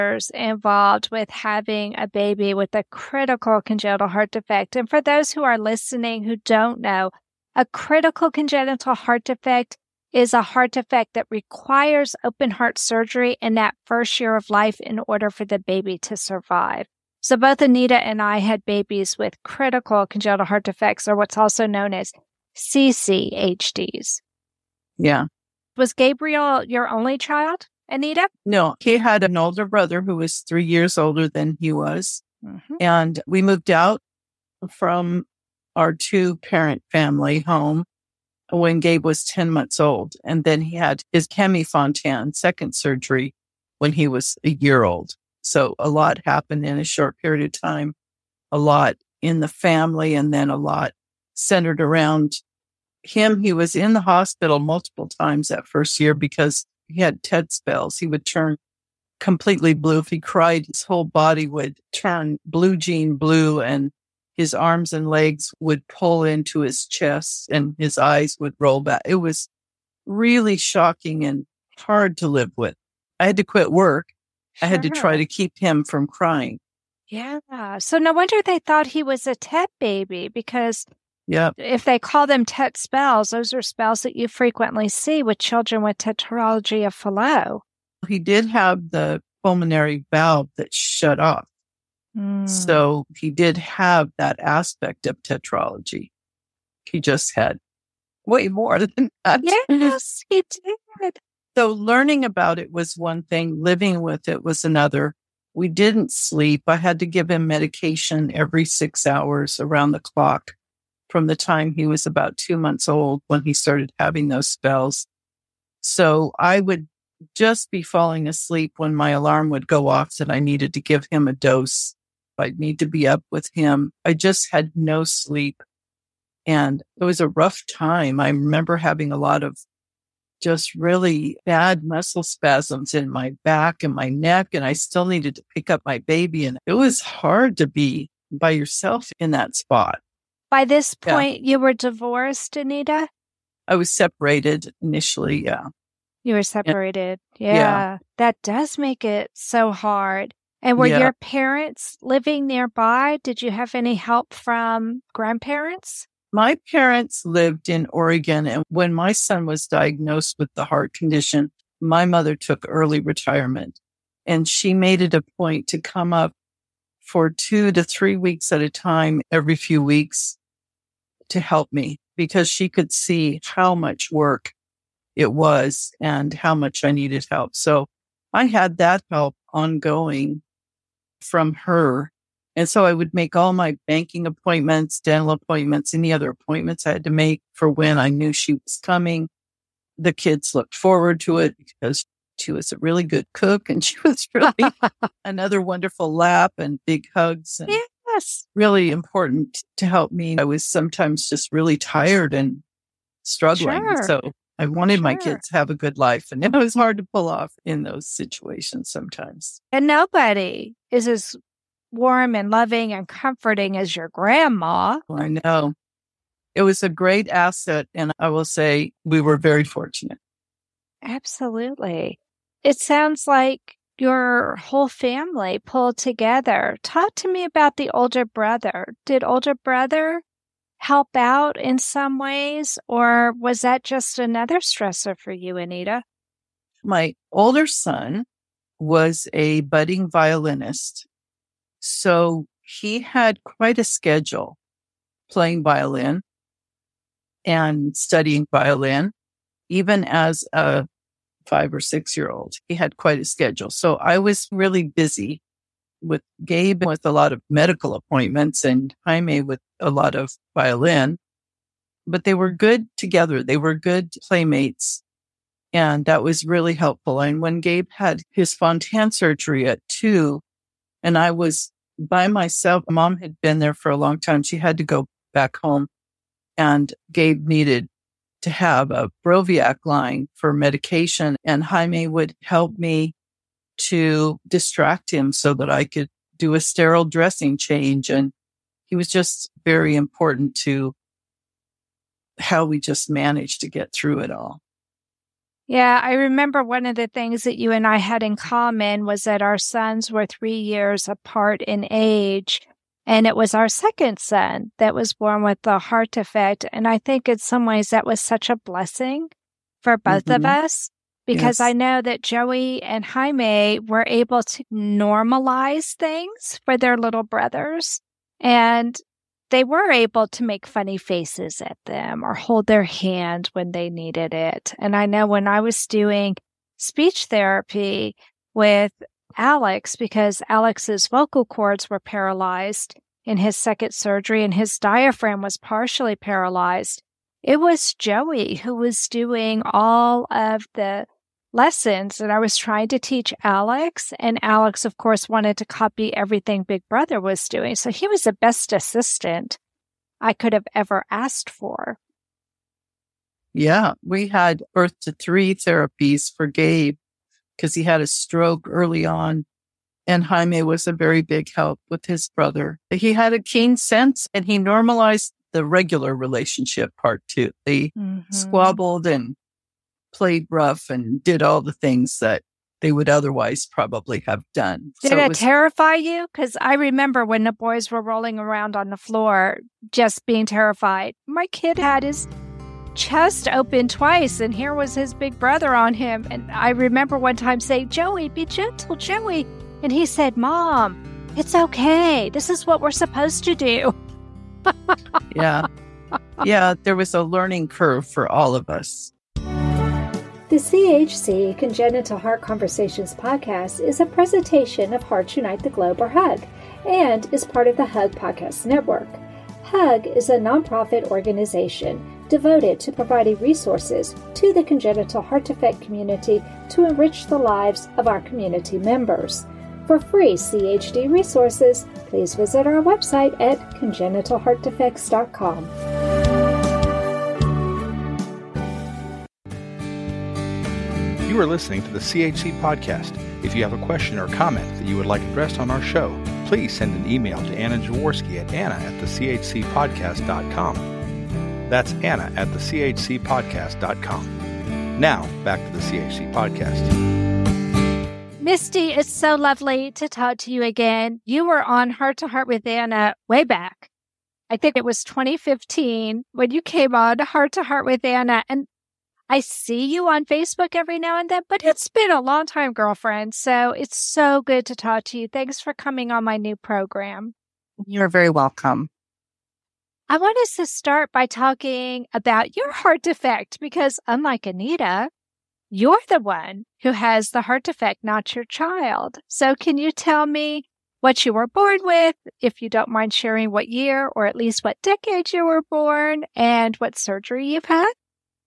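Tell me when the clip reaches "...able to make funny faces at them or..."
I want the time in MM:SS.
05:19.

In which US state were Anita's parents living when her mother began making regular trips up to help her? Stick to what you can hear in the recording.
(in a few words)
Oregon.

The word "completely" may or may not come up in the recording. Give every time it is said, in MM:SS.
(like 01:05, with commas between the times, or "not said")
00:59.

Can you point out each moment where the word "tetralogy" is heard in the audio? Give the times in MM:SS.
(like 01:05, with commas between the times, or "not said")
01:25, 01:35.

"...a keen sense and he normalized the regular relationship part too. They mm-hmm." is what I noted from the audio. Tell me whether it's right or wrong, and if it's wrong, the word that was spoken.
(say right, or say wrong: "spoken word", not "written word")
right.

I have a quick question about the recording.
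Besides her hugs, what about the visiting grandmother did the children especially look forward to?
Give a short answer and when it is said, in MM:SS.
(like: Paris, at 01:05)
Good cook, at 03:13.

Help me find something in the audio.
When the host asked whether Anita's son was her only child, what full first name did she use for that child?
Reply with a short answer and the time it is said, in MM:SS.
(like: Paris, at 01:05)
Gabriel, at 00:25.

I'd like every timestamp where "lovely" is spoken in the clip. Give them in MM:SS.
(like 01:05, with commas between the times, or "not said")
07:29.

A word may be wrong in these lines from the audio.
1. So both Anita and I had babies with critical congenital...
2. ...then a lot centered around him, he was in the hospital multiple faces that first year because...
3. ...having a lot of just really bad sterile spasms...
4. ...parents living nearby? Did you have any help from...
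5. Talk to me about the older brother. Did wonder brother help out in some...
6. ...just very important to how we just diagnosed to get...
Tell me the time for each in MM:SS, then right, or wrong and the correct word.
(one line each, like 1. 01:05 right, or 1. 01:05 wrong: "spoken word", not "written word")
1. 00:17 right
2. 00:50 wrong: "times", not "faces"
3. 02:08 wrong: "muscle", not "sterile"
4. 02:31 right
5. 03:46 wrong: "older", not "wonder"
6. 04:49 wrong: "managed", not "diagnosed".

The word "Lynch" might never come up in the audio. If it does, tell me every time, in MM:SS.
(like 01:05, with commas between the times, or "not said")
not said.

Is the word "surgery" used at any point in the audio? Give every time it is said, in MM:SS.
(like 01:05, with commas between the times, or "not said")
00:12, 00:42, 04:29, 05:33, 08:06.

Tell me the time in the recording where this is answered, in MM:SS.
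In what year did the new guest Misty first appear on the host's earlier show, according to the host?
07:35.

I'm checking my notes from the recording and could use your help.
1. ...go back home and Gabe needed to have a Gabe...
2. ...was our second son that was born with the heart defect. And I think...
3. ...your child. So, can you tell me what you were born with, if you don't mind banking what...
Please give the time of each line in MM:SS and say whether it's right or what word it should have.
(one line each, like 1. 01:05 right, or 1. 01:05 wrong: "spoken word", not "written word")
1. 04:34 wrong: "Broviac", not "Gabe"
2. 05:03 right
3. 07:58 wrong: "sharing", not "banking".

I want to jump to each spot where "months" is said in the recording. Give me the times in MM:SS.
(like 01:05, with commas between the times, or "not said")
00:39, 01:52.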